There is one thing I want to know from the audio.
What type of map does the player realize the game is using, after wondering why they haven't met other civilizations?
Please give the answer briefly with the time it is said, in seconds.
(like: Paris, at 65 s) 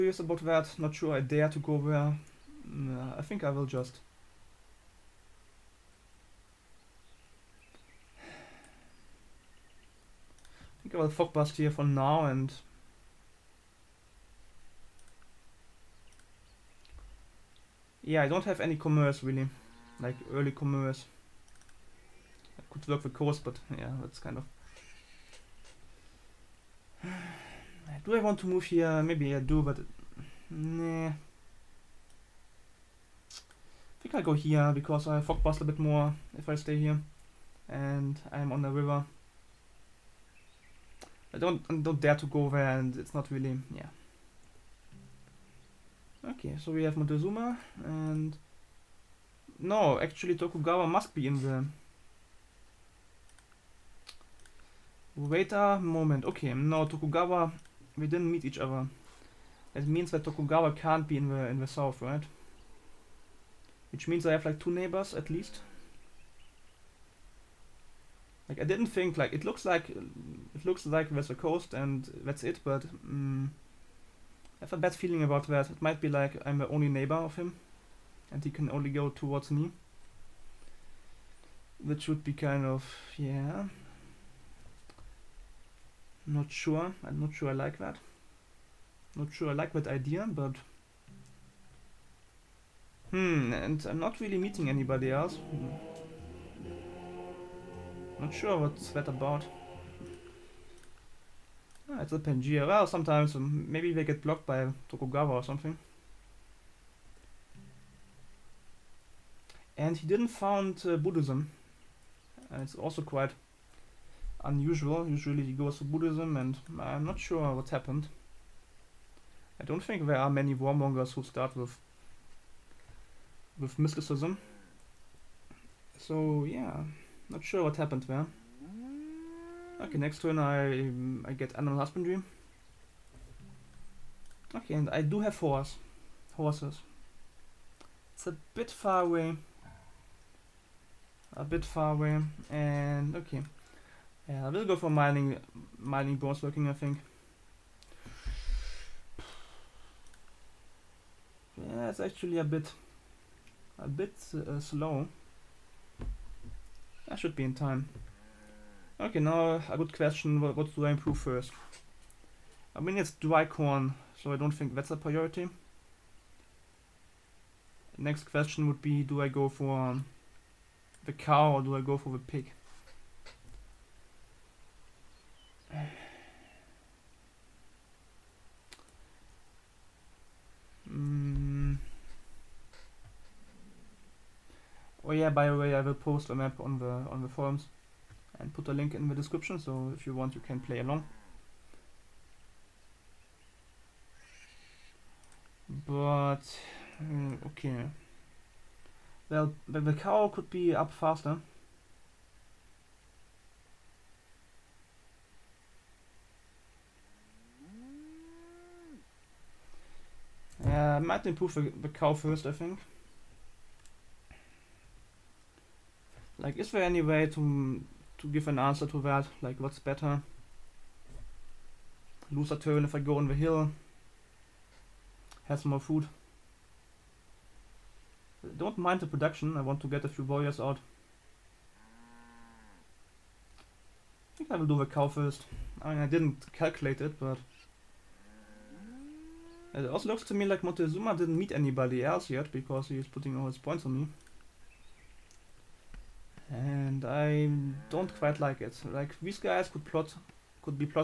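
Pangea, at 102 s.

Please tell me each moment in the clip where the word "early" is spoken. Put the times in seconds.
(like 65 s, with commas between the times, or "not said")
20 s.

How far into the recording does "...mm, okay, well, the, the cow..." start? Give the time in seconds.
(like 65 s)
197 s.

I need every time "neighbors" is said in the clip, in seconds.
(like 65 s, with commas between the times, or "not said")
64 s, 76 s.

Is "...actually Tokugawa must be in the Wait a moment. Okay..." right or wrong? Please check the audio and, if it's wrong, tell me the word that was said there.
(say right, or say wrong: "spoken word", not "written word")
right.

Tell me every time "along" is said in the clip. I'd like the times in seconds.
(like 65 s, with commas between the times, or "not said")
190 s.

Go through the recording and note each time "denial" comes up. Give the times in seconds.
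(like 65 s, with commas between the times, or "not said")
not said.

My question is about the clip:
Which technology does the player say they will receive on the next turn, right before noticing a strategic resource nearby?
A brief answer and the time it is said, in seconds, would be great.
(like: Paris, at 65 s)
Animal Husbandry, at 131 s.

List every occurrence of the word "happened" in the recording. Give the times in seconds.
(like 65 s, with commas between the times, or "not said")
117 s, 127 s.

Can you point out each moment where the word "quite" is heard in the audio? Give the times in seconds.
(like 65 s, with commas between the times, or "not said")
113 s, 248 s.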